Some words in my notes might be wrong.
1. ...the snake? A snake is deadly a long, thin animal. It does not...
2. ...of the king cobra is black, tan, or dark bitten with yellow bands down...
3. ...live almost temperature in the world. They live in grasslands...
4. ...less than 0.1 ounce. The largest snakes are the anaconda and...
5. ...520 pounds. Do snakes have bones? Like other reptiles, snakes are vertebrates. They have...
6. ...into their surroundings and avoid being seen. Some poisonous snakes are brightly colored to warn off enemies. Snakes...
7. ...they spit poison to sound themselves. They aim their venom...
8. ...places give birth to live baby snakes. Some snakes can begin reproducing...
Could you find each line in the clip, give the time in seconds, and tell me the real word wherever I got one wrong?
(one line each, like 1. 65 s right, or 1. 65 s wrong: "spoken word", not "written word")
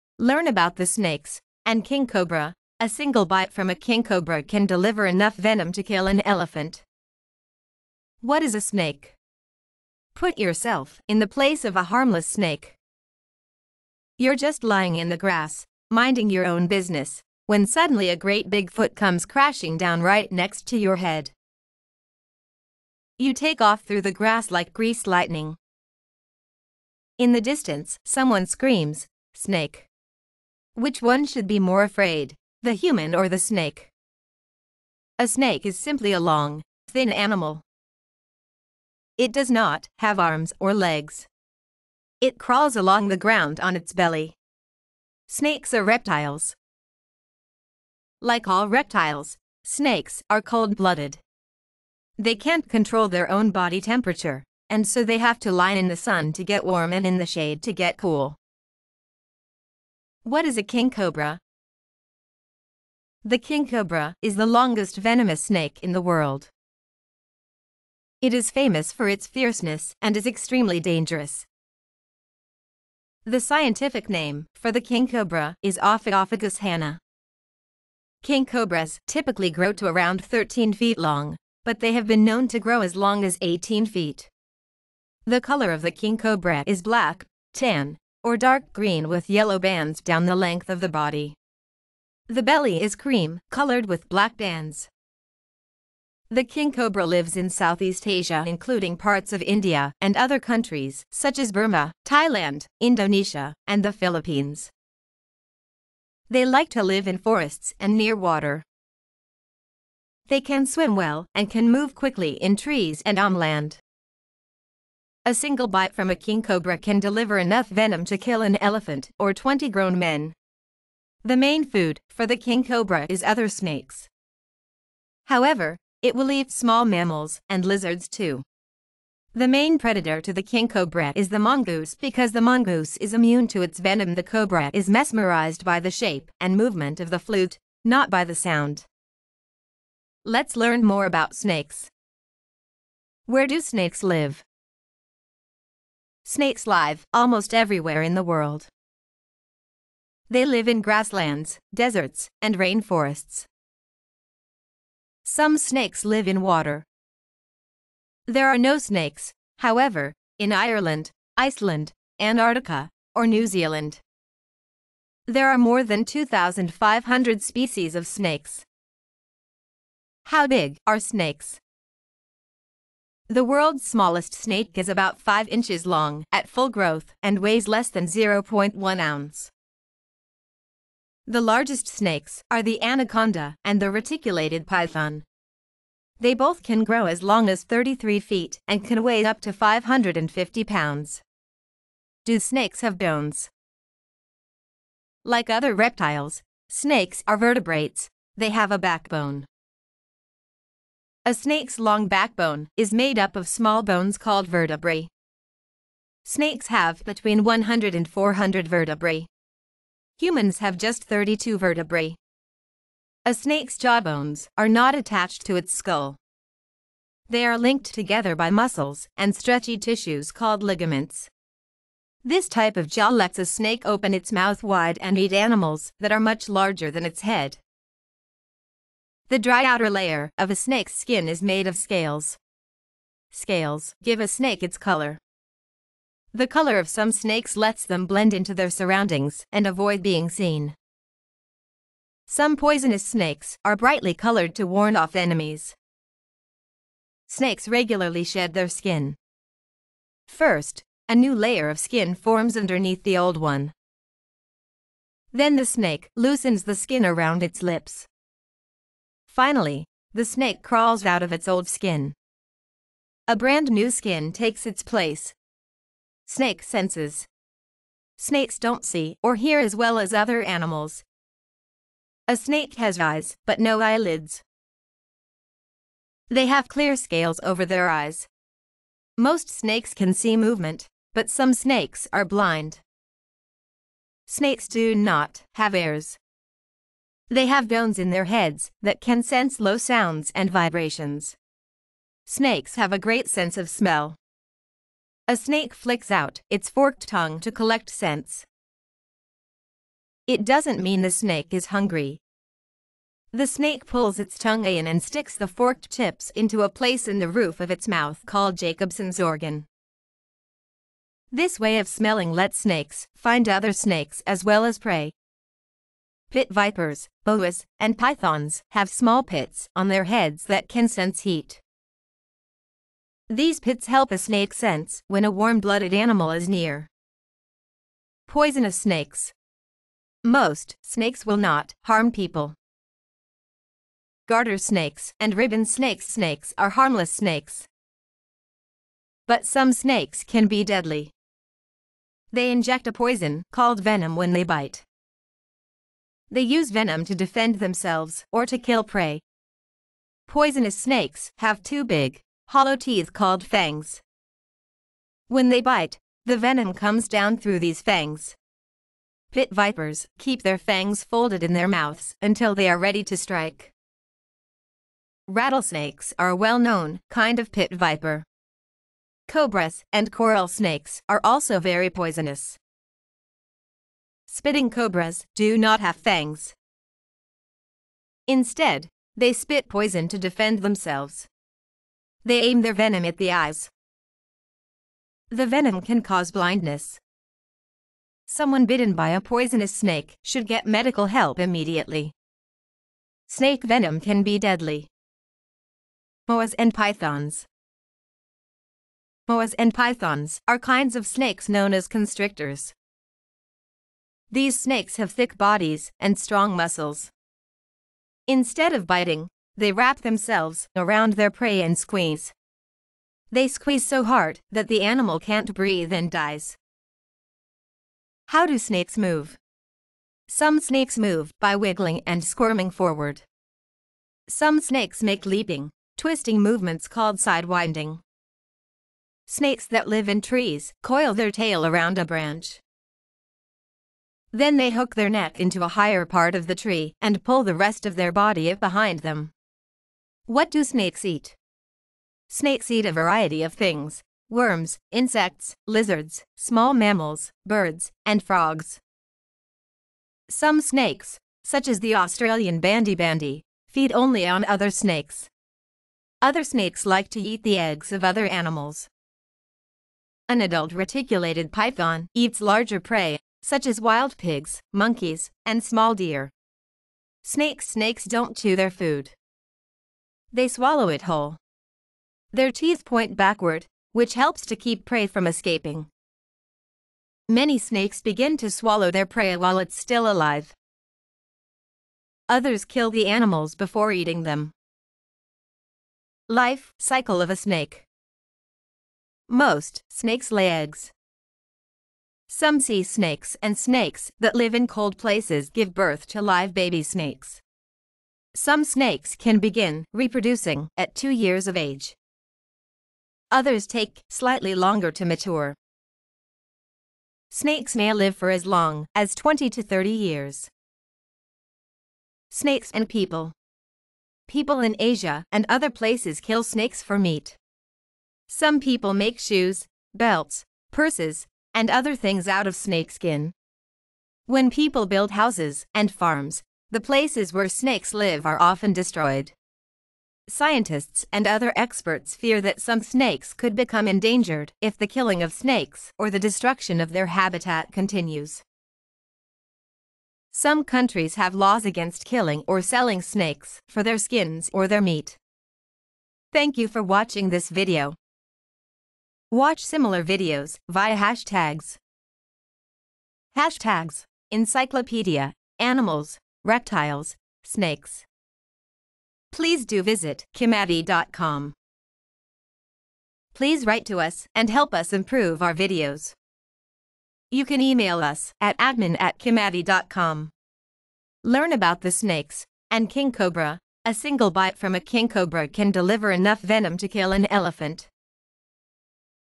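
1. 33 s wrong: "simply", not "deadly"
2. 85 s wrong: "green", not "bitten"
3. 146 s wrong: "everywhere", not "temperature"
4. 177 s right
5. 189 s wrong: "550", not "520"
6. 238 s right
7. 379 s wrong: "defend", not "sound"
8. 494 s right.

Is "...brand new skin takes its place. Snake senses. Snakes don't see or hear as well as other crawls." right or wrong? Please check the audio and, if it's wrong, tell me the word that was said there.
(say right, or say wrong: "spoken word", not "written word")
wrong: "animals", not "crawls".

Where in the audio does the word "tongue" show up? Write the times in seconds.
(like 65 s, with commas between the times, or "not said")
297 s, 304 s.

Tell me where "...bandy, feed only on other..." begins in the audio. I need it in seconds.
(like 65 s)
452 s.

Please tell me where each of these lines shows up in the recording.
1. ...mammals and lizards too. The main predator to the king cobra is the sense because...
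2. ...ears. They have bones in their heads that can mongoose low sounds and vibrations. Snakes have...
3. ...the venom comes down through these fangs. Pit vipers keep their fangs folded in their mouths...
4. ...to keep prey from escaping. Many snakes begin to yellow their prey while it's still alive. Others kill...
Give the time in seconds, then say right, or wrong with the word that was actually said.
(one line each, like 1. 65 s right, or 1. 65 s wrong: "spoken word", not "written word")
1. 126 s wrong: "mongoose", not "sense"
2. 285 s wrong: "sense", not "mongoose"
3. 356 s right
4. 474 s wrong: "swallow", not "yellow".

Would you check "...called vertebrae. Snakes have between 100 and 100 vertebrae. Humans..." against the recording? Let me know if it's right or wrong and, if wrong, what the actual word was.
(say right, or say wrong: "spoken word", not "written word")
wrong: "400", not "100".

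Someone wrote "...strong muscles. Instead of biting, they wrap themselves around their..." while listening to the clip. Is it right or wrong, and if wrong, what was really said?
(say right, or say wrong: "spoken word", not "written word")
right.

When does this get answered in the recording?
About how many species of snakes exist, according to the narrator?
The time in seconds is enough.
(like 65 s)
165 s.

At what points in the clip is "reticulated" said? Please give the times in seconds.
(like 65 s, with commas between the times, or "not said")
183 s, 460 s.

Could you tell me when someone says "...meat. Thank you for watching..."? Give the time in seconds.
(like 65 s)
544 s.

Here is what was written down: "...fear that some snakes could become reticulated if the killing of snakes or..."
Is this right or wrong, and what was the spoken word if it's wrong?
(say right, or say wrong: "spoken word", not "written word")
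wrong: "endangered", not "reticulated".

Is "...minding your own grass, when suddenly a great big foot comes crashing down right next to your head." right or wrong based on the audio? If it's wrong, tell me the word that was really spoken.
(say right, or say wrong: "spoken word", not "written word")
wrong: "business", not "grass".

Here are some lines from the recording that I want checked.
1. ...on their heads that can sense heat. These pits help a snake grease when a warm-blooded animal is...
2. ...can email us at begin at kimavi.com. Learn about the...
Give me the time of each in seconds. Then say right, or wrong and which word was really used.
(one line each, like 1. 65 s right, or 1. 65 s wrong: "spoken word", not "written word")
1. 319 s wrong: "sense", not "grease"
2. 567 s wrong: "admin", not "begin".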